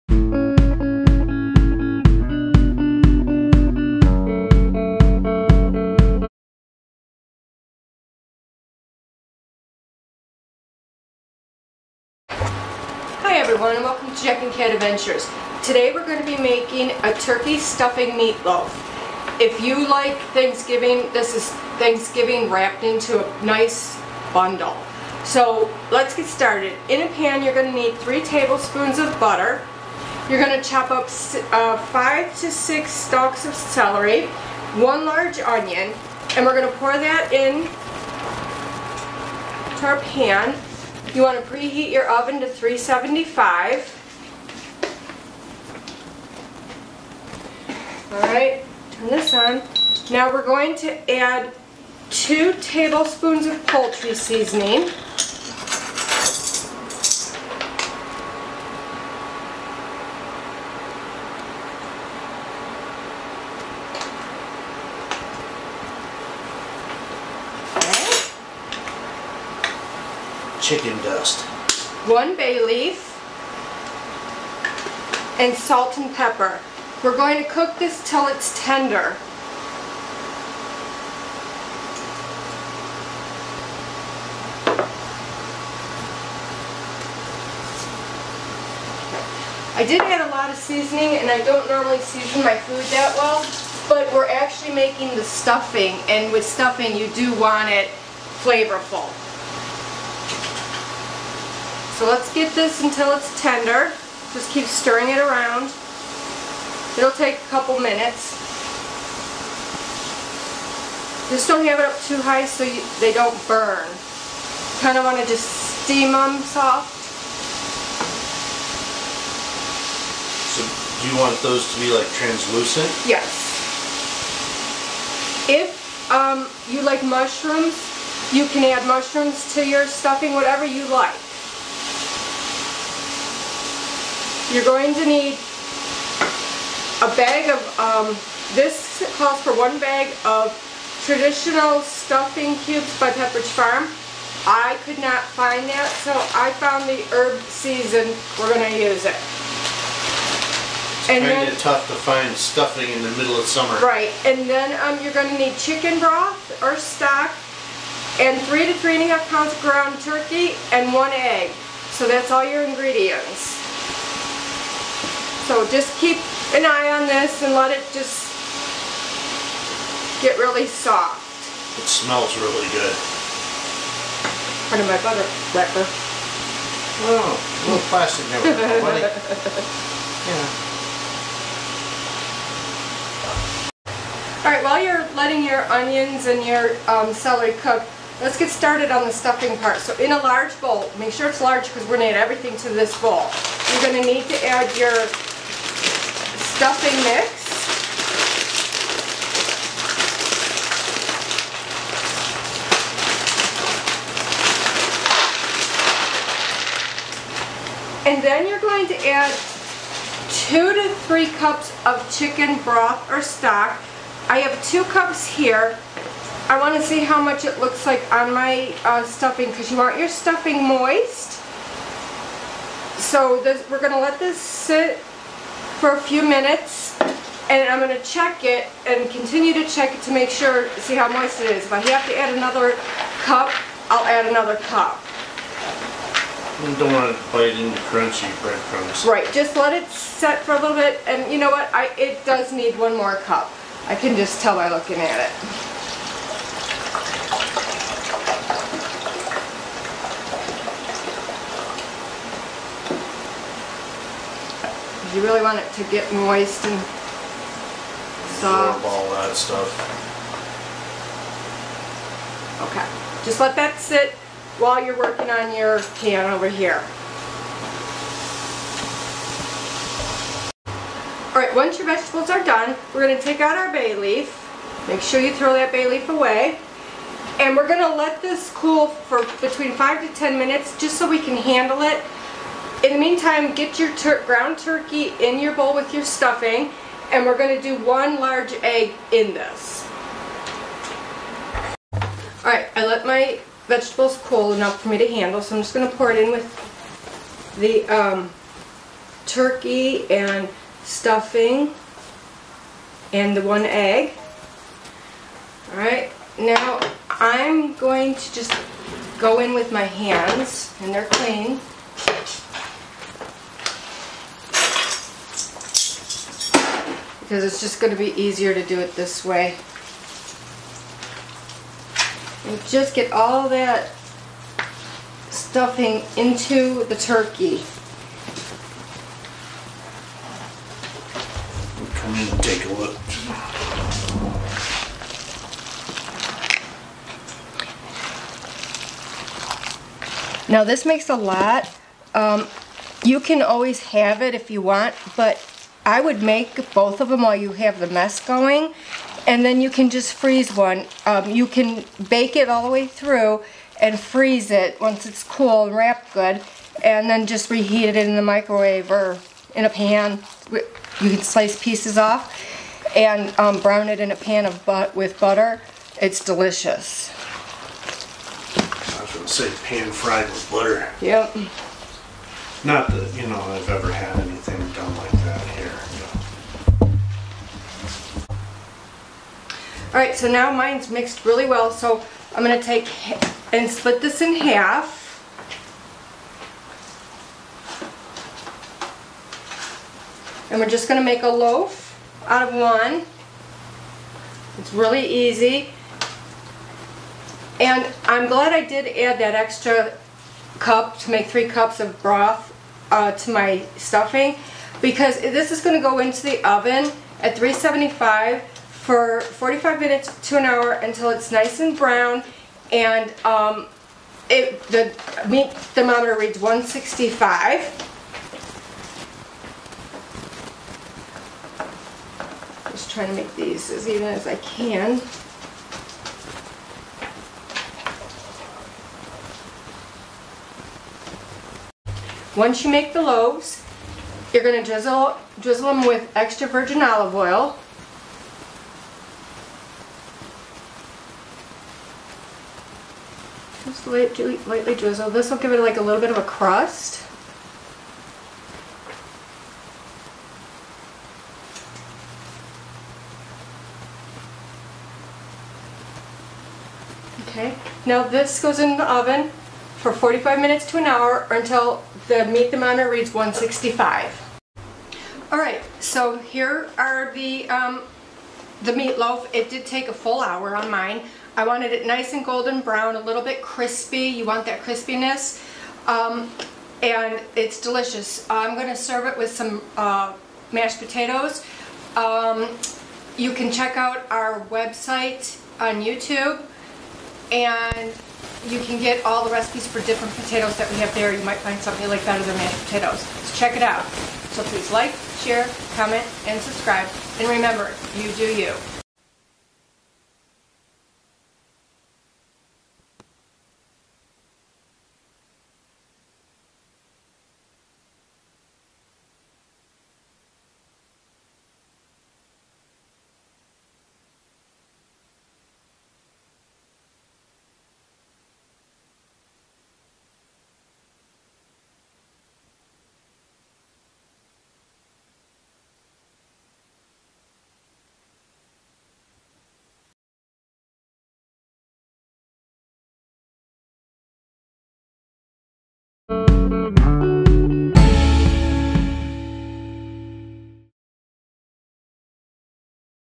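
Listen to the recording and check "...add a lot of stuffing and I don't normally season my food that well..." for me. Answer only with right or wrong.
wrong.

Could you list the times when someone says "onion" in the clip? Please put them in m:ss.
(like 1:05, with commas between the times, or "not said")
0:35, 3:05.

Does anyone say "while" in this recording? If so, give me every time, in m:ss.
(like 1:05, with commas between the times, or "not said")
3:04, 4:24, 5:47.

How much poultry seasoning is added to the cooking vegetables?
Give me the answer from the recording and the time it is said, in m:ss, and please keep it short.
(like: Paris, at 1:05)
2 tablespoons, at 0:52.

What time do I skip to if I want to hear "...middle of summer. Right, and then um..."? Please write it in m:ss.
2:33.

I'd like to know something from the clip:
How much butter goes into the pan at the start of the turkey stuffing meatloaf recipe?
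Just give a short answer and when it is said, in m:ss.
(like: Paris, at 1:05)
3 tablespoons, at 0:27.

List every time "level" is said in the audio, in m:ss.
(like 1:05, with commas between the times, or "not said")
not said.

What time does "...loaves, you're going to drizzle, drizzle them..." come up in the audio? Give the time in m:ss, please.
7:13.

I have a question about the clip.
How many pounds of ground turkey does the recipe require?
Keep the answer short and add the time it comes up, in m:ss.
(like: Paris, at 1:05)
3 to 3.5 pounds, at 2:38.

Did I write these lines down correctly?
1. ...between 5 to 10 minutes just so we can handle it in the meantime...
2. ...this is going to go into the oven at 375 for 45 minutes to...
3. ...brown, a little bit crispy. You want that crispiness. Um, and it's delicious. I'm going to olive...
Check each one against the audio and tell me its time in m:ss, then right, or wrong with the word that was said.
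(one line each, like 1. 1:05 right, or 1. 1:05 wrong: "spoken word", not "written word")
1. 4:39 right
2. 6:45 right
3. 7:52 wrong: "serve", not "olive".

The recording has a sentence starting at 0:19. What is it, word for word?
If you like Thanksgiving, this is Thanksgiving wrapped into a nice bundle.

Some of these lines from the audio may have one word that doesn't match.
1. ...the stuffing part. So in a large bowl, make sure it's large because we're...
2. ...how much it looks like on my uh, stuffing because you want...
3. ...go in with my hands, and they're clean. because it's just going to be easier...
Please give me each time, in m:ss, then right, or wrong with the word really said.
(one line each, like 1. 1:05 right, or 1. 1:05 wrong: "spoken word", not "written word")
1. 3:09 right
2. 3:36 right
3. 5:09 right.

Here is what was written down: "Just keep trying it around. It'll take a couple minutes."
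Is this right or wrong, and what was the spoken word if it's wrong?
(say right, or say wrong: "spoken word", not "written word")
wrong: "stirring", not "trying".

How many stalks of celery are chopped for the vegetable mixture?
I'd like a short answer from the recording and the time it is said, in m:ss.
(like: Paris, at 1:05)
5 to 6, at 0:31.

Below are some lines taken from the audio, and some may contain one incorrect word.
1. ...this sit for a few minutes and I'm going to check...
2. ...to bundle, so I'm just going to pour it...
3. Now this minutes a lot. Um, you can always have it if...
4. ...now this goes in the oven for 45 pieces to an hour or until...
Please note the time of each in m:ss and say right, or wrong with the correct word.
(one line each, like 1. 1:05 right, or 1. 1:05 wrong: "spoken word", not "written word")
1. 3:44 right
2. 4:54 wrong: "handle", not "bundle"
3. 5:40 wrong: "makes", not "minutes"
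4. 7:37 wrong: "minutes", not "pieces".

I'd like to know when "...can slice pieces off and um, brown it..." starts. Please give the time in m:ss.
6:01.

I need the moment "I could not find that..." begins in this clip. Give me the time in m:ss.
2:24.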